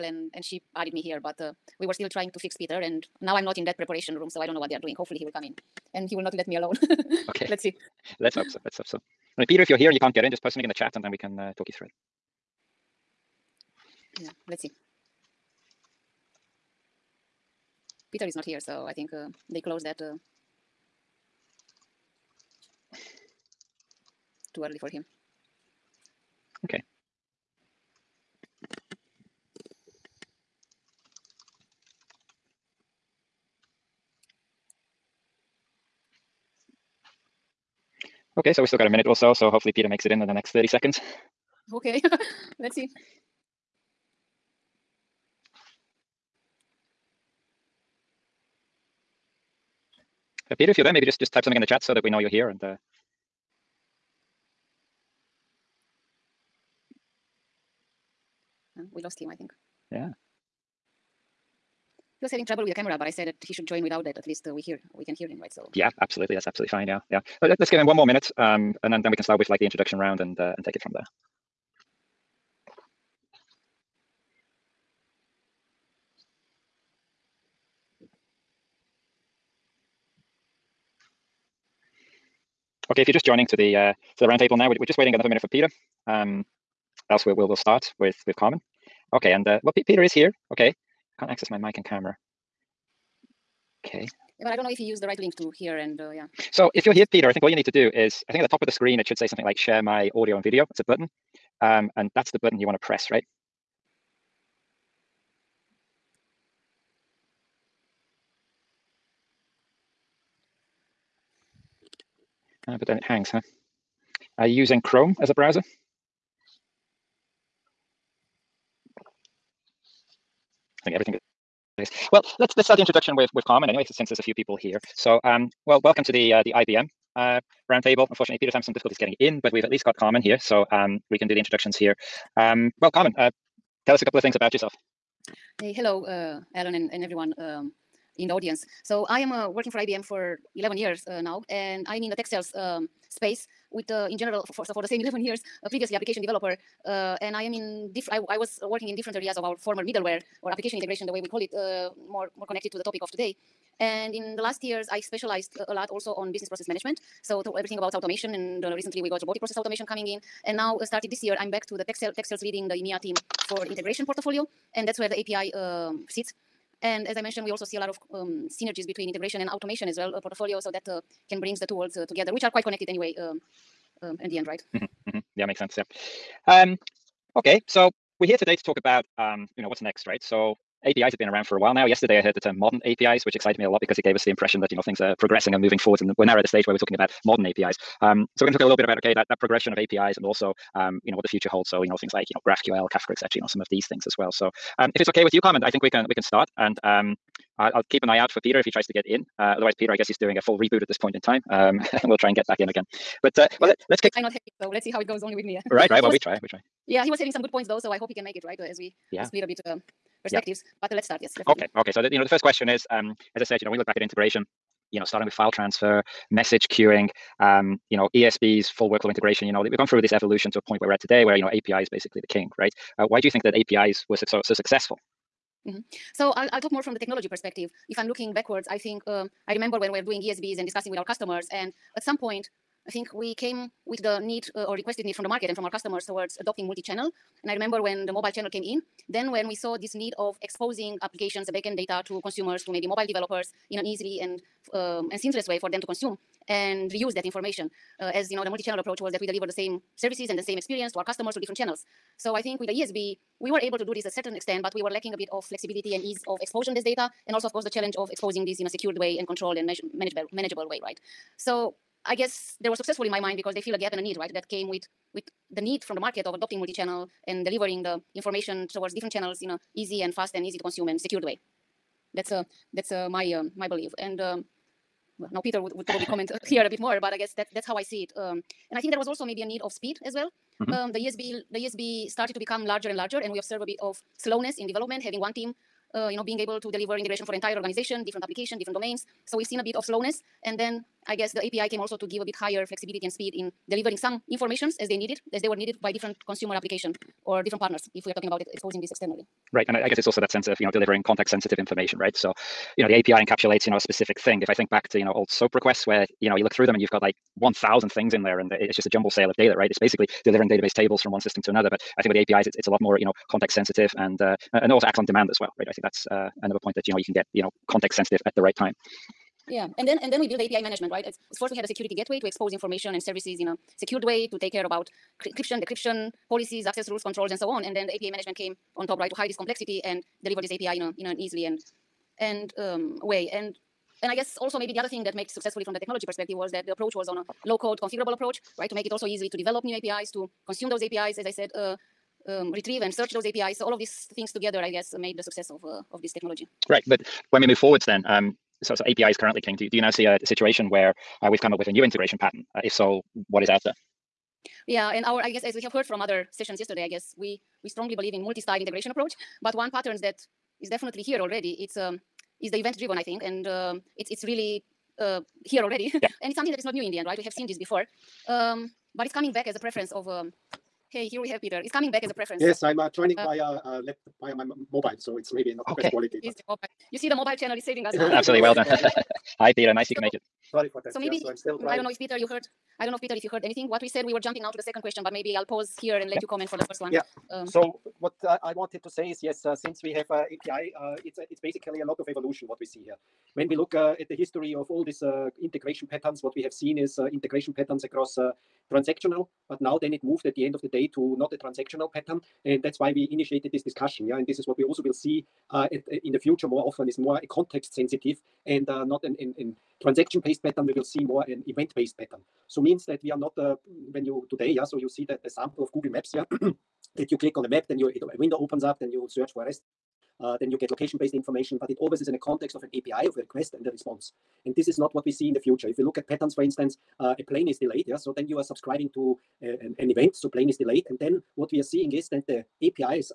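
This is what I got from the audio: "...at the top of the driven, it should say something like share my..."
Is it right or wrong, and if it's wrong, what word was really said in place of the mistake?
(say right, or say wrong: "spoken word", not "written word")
wrong: "screen", not "driven".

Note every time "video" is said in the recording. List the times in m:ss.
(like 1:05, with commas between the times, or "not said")
1:40.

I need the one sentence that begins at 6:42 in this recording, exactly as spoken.
And that's why we initiated this discussion.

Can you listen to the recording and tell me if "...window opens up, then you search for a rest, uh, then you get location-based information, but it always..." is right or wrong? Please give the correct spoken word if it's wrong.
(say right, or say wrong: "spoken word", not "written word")
right.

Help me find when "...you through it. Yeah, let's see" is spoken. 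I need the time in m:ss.
0:11.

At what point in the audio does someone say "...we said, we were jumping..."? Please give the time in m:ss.
6:23.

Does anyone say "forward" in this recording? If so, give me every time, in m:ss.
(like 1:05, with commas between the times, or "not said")
3:05, 5:47.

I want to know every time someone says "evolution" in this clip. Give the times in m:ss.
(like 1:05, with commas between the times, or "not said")
3:40, 6:32.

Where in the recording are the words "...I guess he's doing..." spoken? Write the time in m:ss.
3:19.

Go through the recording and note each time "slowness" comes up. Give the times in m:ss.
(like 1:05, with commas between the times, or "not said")
4:44, 4:49.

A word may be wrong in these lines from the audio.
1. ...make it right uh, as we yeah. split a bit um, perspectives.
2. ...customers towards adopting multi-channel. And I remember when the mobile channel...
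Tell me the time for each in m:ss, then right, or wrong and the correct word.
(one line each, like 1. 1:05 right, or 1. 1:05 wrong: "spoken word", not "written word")
1. 3:28 right
2. 3:55 right.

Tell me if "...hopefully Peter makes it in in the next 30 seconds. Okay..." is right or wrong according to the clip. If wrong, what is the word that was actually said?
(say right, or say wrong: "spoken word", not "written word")
right.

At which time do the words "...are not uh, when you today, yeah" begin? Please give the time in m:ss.
6:53.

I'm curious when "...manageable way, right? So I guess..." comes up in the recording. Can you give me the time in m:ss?
4:20.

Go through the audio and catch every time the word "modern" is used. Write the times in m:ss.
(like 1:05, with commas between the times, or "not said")
3:02, 3:07.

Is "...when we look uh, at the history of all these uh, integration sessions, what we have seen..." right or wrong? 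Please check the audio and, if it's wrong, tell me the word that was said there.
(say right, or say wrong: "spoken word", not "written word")
wrong: "patterns", not "sessions".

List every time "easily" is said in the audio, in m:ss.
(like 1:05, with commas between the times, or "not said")
4:03, 5:31, 5:39.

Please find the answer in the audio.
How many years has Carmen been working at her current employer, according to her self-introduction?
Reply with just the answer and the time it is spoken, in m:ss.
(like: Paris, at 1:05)
11, at 2:20.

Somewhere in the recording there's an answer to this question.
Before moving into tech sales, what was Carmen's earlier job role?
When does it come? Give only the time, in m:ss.
2:25.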